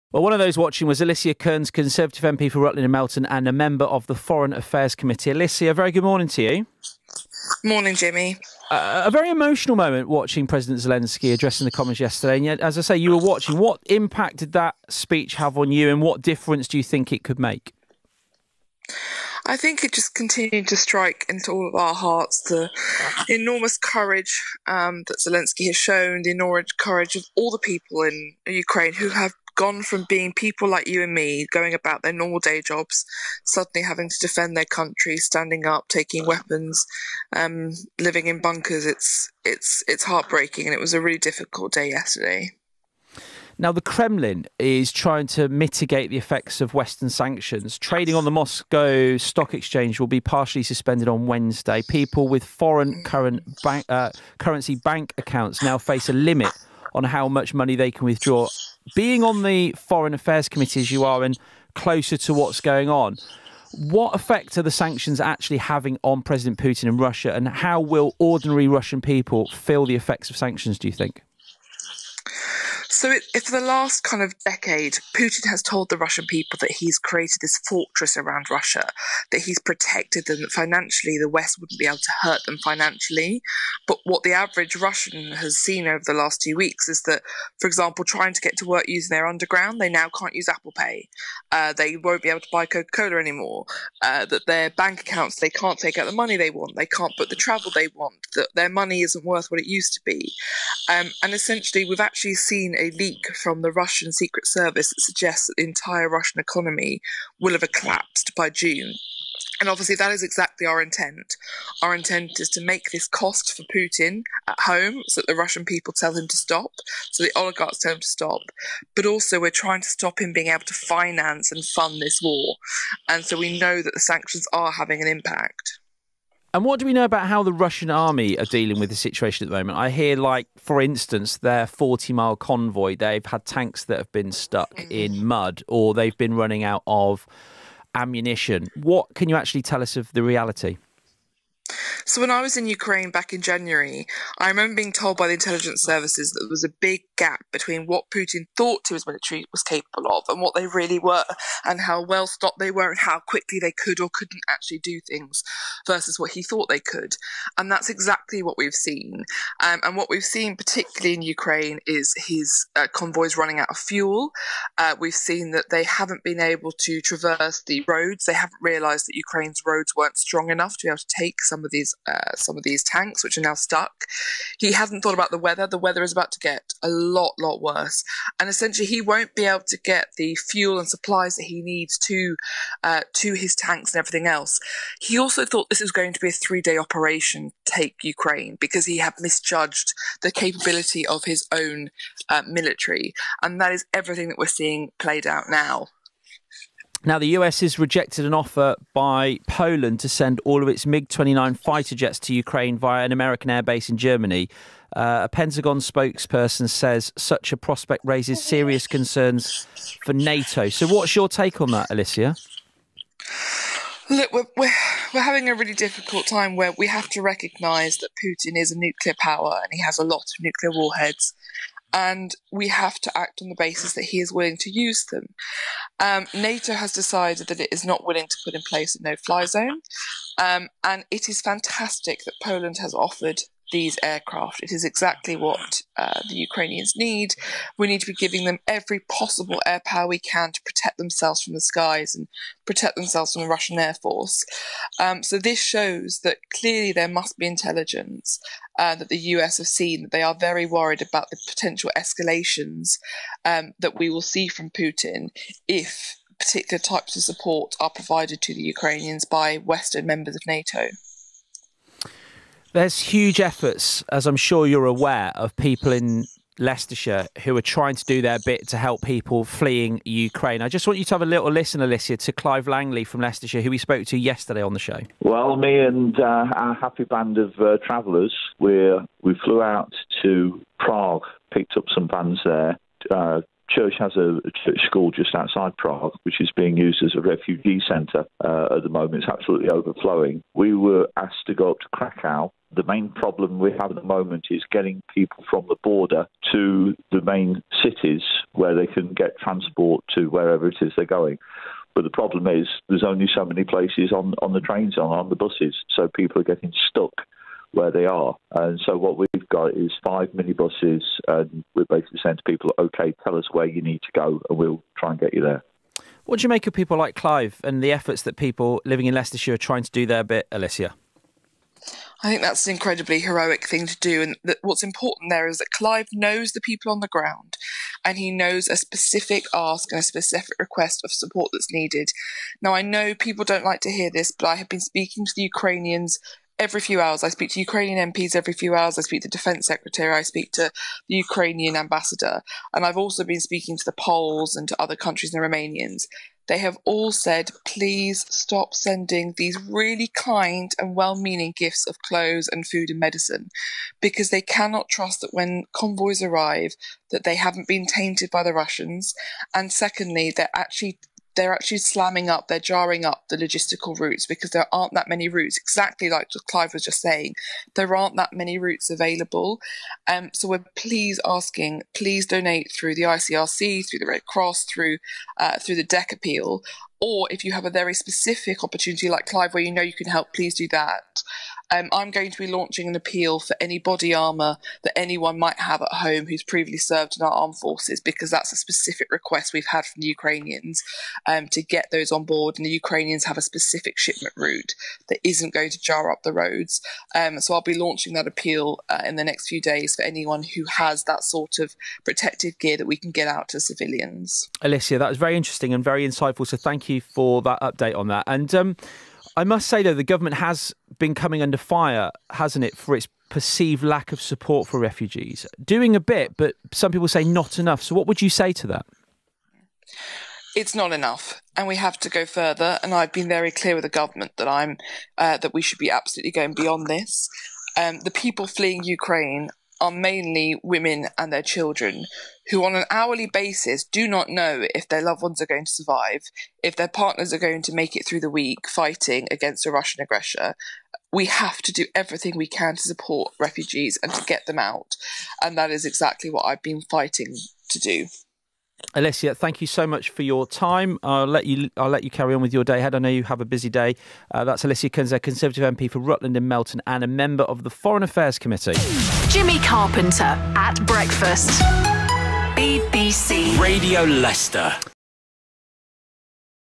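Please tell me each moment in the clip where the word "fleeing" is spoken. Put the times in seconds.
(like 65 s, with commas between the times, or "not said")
269 s, 428 s.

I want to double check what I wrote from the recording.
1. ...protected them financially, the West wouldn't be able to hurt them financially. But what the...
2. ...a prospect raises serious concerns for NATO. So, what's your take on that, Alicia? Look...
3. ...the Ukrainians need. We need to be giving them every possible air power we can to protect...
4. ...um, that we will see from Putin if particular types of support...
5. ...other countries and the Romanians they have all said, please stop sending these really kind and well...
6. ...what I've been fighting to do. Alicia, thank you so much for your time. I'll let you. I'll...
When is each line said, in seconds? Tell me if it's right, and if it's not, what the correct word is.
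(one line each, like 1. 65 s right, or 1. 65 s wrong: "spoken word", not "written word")
1. 79 s right
2. 207 s right
3. 236 s right
4. 253 s right
5. 344 s right
6. 446 s right.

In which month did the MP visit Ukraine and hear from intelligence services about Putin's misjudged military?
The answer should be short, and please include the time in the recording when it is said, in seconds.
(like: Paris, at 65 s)
January, at 143 s.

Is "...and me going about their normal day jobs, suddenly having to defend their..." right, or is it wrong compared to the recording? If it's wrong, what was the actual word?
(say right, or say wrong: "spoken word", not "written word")
right.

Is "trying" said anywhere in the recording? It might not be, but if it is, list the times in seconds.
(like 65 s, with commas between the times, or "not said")
44 s, 88 s, 119 s, 267 s, 319 s.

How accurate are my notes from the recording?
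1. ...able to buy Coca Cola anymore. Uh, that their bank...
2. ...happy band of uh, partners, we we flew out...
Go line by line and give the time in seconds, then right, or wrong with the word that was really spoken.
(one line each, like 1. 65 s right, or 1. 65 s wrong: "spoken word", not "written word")
1. 92 s right
2. 276 s wrong: "travellers", not "partners".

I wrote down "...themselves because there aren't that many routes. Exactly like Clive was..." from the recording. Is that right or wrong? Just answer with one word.
wrong.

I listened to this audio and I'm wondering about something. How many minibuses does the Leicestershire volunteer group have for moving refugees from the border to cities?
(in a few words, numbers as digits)
5.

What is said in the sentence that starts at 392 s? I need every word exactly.
And the Ukrainians have a specific shipment route that isn't going to jar up the roads.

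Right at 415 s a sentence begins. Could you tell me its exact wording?
Doing a bit, but some people say not enough.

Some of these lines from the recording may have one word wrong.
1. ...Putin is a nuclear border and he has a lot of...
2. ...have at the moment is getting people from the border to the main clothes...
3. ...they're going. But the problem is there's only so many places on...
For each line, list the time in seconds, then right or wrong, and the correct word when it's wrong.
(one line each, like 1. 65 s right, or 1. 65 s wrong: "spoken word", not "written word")
1. 218 s wrong: "power", not "border"
2. 293 s wrong: "cities", not "clothes"
3. 300 s right.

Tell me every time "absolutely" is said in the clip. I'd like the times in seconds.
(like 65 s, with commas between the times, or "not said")
289 s, 425 s.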